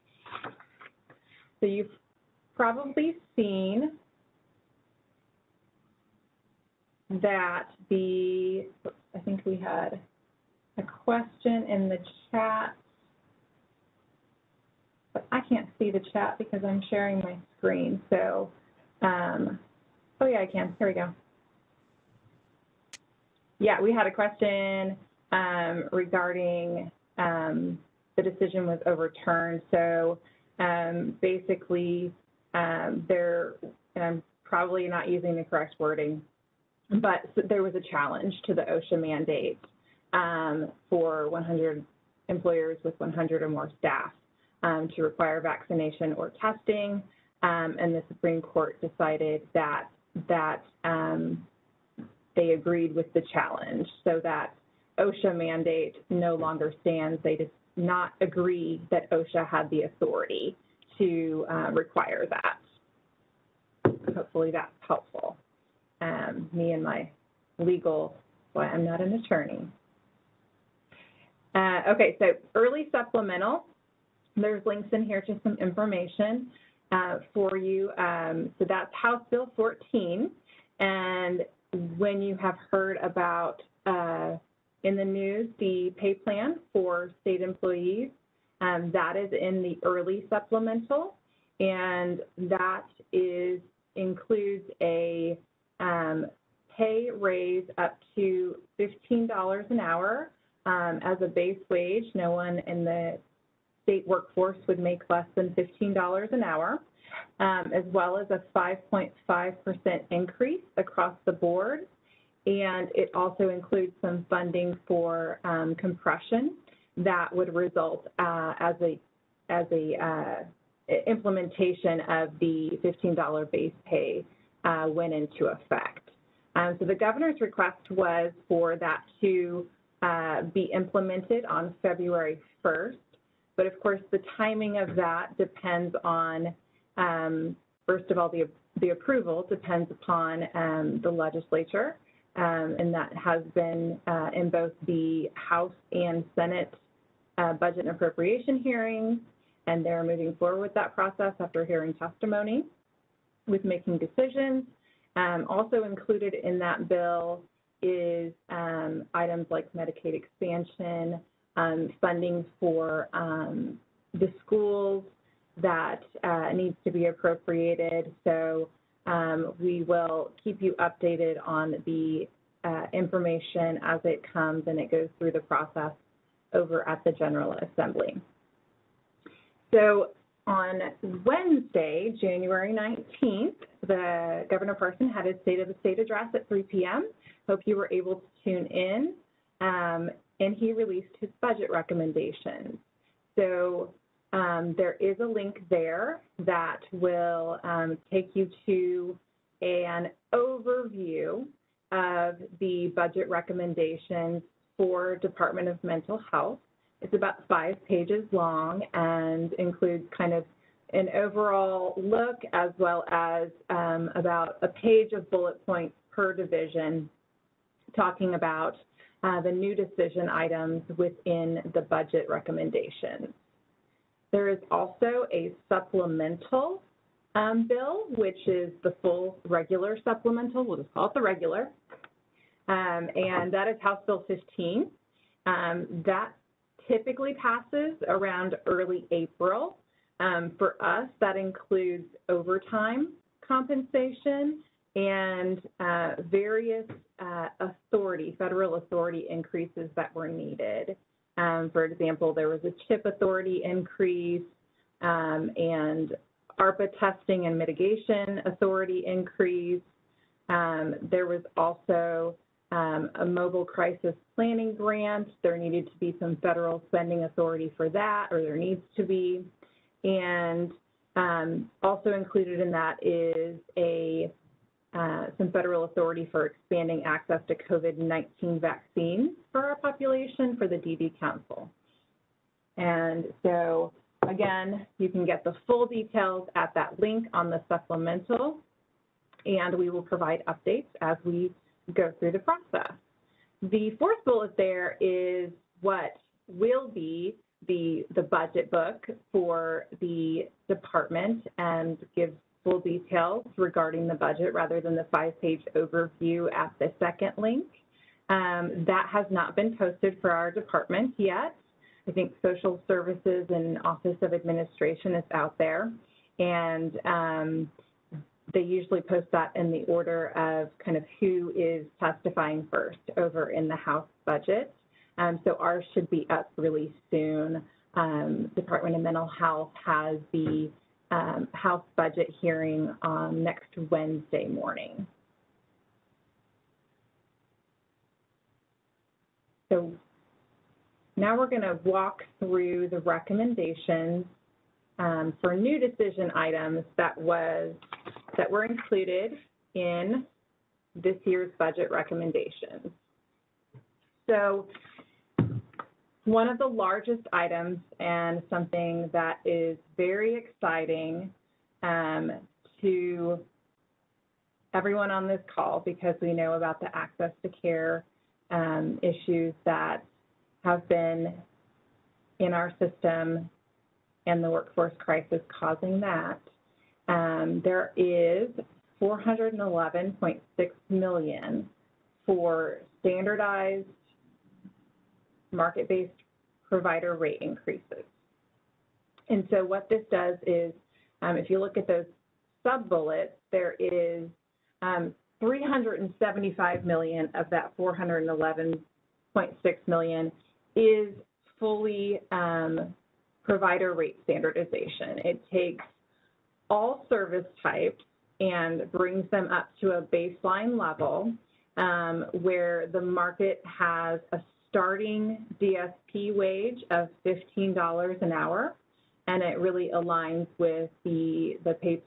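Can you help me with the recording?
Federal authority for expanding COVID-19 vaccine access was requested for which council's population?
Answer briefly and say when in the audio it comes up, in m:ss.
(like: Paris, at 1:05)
DD Council, at 4:40.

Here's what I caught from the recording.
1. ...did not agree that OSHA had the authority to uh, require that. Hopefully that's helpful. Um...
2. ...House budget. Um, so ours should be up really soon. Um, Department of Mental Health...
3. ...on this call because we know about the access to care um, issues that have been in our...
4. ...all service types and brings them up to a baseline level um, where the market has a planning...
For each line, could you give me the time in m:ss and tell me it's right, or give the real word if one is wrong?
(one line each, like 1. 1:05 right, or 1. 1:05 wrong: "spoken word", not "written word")
1. 0:57 right
2. 5:23 right
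3. 6:05 right
4. 6:46 wrong: "starting", not "planning".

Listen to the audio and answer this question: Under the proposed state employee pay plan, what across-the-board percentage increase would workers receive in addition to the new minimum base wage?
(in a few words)
5.5%.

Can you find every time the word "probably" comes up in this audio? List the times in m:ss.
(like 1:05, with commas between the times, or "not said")
0:02, 0:34.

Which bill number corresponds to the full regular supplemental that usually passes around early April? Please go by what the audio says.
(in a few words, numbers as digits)
House Bill 15.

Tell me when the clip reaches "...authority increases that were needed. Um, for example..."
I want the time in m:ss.
4:08.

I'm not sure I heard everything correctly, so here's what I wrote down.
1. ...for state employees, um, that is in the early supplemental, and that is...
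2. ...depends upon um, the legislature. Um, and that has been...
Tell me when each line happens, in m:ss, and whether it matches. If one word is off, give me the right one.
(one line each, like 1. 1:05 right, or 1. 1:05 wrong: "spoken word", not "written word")
1. 1:26 right
2. 2:19 right.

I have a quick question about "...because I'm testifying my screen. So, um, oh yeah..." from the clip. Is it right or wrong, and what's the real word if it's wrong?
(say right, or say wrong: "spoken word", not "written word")
wrong: "sharing", not "testifying".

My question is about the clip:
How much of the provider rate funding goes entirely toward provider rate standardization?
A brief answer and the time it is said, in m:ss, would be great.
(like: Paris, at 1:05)
$375 million, at 6:35.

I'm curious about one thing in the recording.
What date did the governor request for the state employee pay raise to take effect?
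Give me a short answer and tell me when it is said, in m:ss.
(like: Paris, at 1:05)
February 1st, at 2:11.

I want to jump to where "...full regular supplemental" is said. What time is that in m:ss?
3:49.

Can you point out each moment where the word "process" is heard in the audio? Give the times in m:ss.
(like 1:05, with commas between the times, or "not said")
2:30, 2:55, 4:52.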